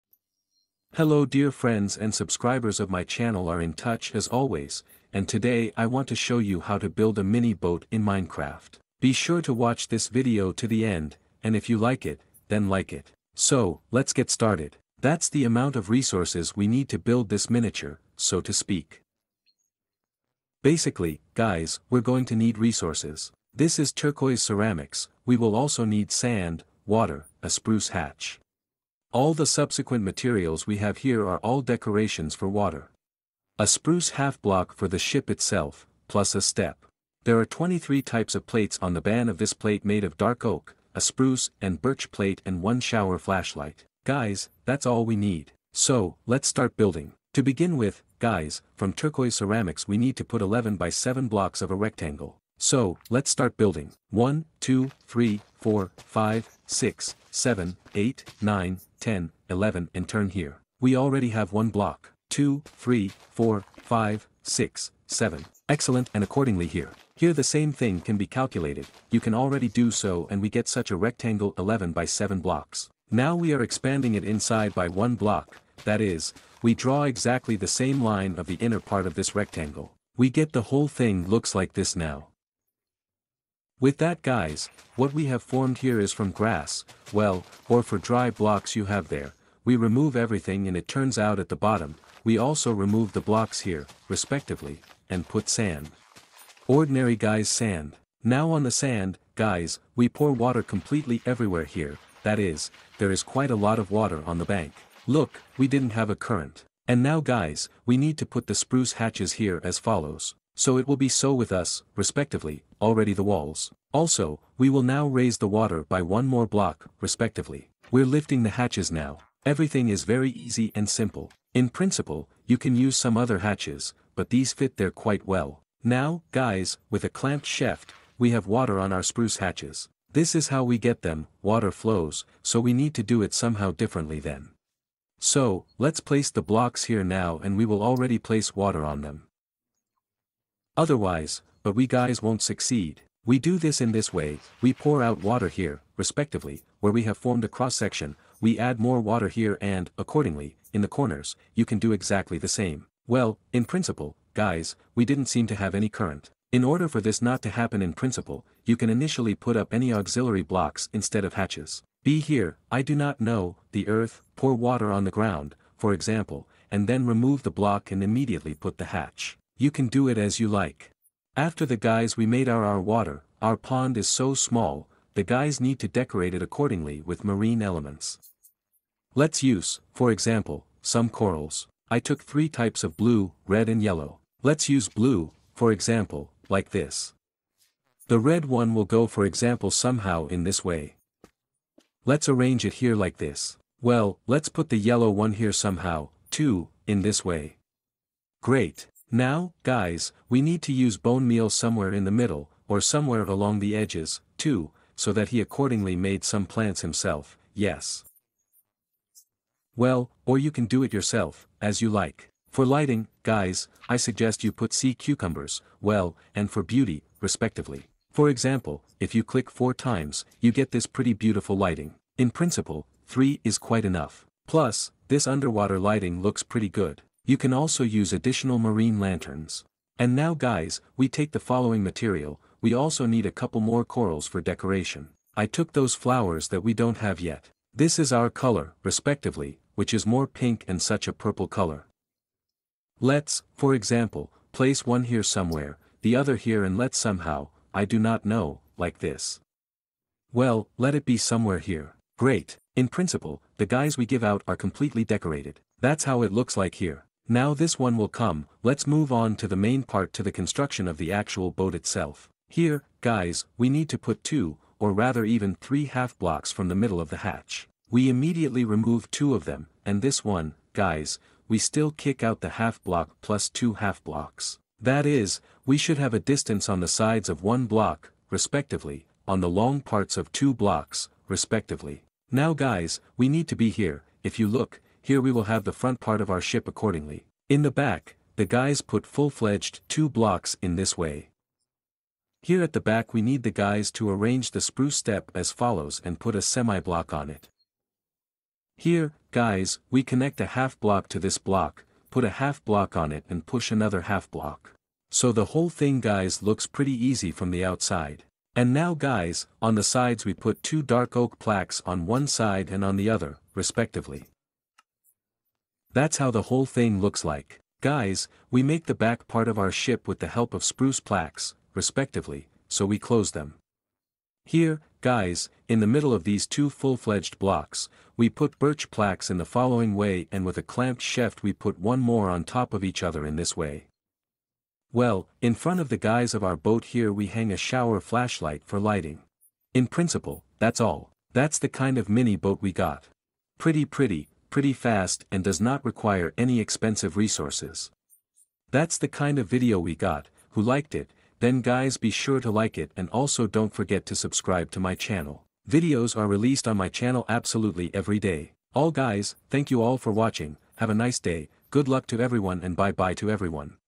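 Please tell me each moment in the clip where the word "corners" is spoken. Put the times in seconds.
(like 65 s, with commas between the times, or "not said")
150 s.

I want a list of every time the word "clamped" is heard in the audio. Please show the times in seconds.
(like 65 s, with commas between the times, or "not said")
127 s, 330 s.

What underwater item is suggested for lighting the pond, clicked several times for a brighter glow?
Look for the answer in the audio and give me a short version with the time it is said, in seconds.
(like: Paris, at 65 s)
Sea cucumbers, at 214 s.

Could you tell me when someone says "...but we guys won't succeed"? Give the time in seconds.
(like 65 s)
141 s.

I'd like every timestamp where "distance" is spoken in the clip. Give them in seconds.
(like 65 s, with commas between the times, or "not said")
276 s.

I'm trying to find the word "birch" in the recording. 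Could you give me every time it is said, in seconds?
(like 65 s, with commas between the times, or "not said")
41 s, 328 s.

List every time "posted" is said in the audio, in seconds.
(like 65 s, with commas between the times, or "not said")
not said.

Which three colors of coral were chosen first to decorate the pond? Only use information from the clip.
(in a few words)
Blue, red and yellow.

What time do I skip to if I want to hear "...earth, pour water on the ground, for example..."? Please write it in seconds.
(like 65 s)
163 s.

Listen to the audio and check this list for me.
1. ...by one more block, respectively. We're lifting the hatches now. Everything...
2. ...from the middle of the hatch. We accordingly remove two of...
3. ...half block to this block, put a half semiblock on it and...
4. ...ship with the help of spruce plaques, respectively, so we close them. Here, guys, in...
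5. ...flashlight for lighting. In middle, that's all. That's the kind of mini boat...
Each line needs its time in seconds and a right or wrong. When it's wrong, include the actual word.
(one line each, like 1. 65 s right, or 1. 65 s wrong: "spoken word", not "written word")
1. 115 s right
2. 266 s wrong: "immediately", not "accordingly"
3. 300 s wrong: "block", not "semiblock"
4. 319 s right
5. 337 s wrong: "principle", not "middle".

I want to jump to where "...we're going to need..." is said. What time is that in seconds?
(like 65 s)
21 s.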